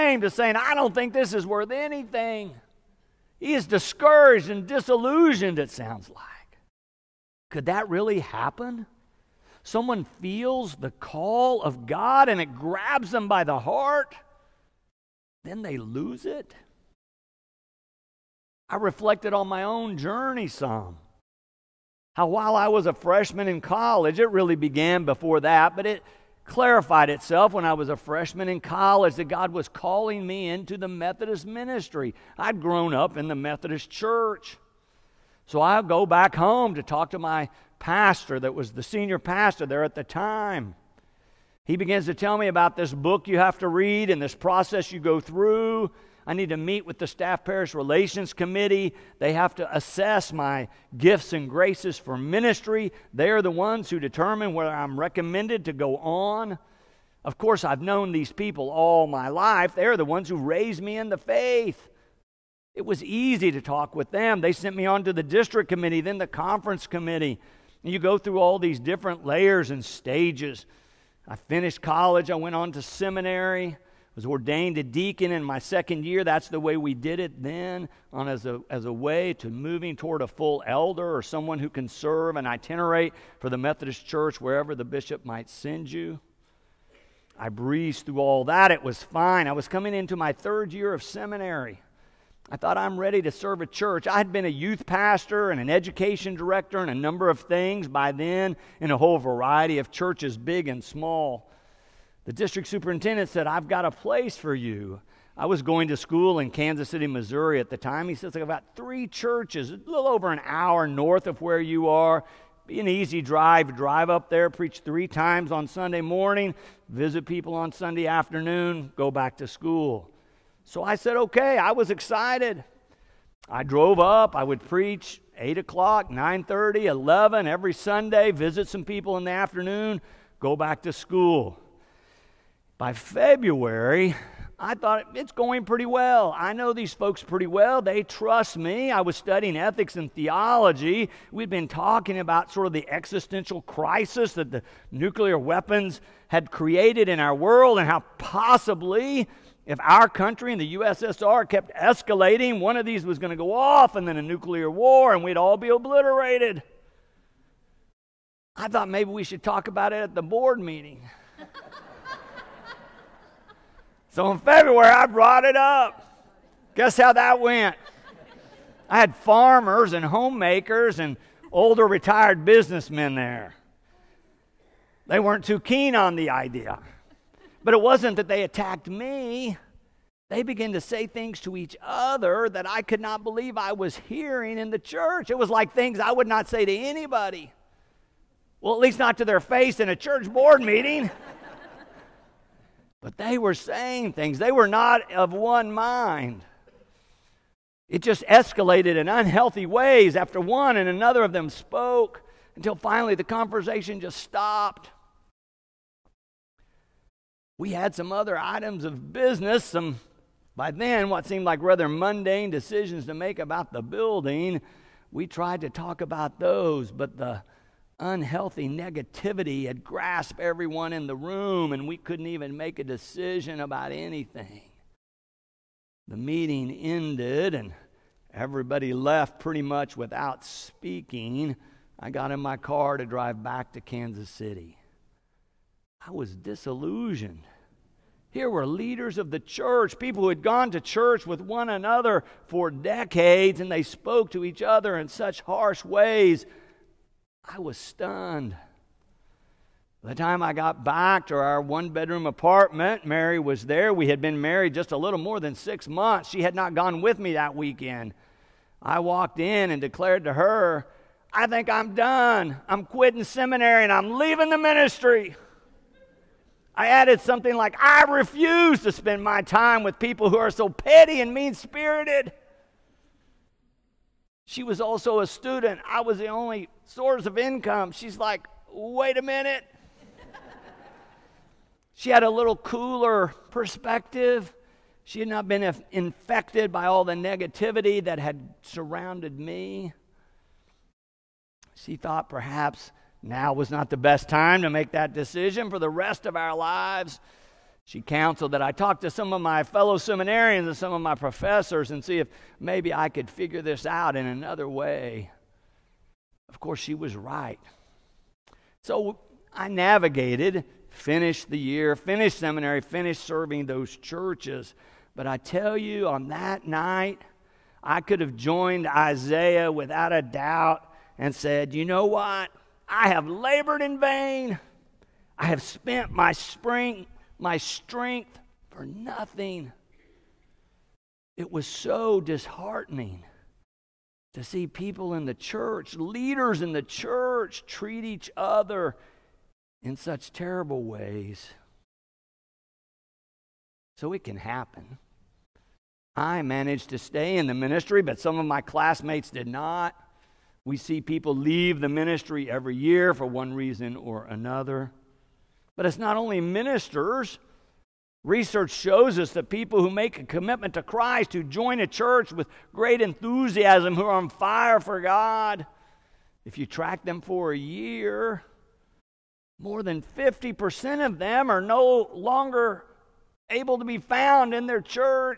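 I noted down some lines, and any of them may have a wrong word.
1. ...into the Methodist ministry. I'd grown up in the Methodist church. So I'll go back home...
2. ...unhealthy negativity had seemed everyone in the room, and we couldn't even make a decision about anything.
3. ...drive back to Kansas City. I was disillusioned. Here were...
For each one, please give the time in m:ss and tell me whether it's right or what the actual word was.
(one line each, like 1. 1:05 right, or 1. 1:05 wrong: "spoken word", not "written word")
1. 0:30 right
2. 3:37 wrong: "grasped", not "seemed"
3. 3:53 right.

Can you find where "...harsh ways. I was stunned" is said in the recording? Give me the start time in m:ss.
4:05.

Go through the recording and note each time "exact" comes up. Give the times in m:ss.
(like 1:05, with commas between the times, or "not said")
not said.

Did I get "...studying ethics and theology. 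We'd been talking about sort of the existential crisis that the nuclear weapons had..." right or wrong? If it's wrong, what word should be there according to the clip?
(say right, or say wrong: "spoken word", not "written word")
right.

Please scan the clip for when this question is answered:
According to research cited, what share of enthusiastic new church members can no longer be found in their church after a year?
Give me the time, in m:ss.
6:09.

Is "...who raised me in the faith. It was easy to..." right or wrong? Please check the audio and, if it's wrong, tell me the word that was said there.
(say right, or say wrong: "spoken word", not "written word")
right.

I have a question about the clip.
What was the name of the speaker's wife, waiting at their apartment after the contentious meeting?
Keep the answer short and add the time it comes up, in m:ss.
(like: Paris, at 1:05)
Mary, at 4:13.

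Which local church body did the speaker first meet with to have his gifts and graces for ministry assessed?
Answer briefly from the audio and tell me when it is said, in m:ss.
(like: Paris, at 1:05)
Staff Parish Relations Committee, at 0:47.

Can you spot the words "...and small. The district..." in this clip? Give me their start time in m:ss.
1:40.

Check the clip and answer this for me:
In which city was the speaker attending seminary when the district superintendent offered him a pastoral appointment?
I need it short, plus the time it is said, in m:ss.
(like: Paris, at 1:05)
Kansas City, Missouri, at 1:46.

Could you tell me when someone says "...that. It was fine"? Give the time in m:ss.
1:28.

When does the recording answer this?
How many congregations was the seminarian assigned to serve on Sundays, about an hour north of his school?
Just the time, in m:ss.
1:48.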